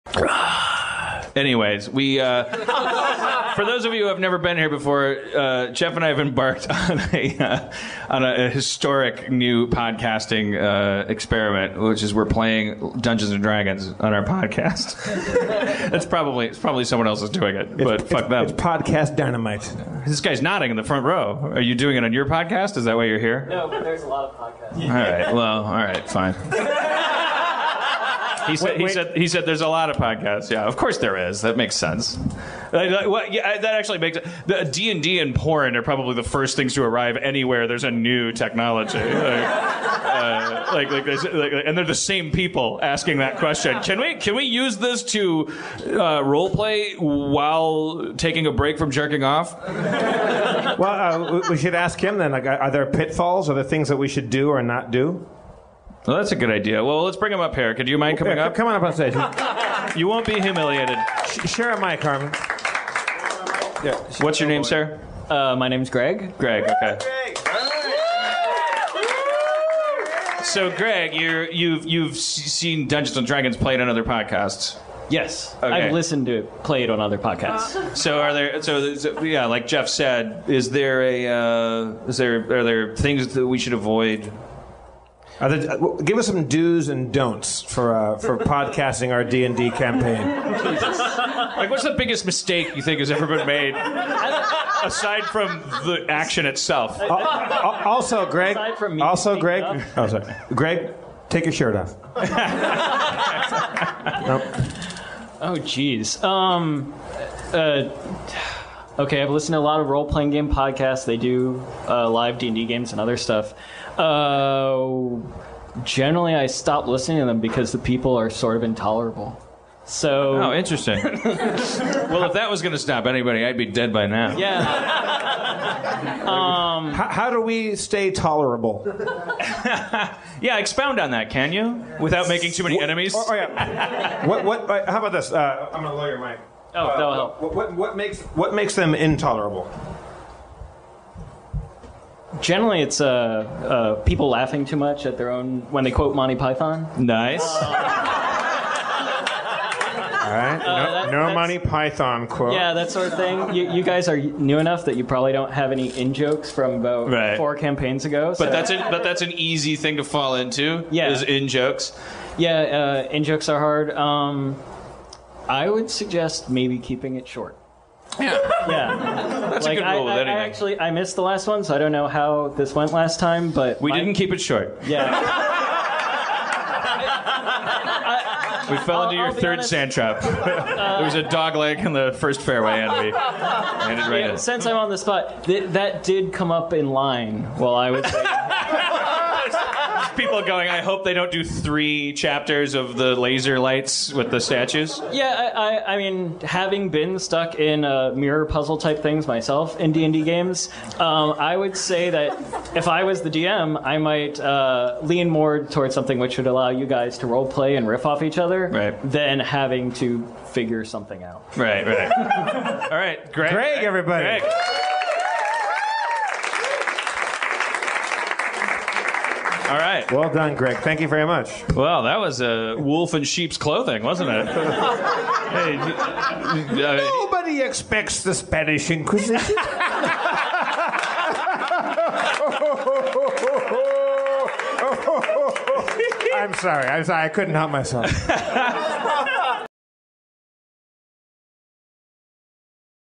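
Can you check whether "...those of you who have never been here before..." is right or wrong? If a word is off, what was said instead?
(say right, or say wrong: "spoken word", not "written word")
right.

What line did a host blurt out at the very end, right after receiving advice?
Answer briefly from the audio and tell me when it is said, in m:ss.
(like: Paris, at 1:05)
Nobody expects the Spanish Inquisition, at 3:46.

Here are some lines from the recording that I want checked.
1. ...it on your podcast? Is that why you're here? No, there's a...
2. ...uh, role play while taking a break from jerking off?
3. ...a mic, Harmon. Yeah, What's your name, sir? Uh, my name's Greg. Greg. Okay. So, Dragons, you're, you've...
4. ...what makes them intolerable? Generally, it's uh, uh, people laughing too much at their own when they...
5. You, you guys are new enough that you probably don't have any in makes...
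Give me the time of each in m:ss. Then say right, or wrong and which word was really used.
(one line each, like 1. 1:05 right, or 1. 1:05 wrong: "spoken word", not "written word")
1. 0:21 right
2. 0:45 right
3. 1:01 wrong: "Greg", not "Dragons"
4. 2:18 right
5. 2:33 wrong: "jokes", not "makes".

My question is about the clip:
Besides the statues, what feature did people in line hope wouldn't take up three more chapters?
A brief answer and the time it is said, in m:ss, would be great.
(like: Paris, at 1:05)
laser lights, at 3:13.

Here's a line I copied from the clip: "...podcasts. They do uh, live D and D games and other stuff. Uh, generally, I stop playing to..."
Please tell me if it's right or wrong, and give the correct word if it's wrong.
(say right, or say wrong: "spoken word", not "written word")
wrong: "listening", not "playing".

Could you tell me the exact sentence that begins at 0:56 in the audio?
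Well, let's bring him up here.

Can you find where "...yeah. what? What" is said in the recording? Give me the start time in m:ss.
2:13.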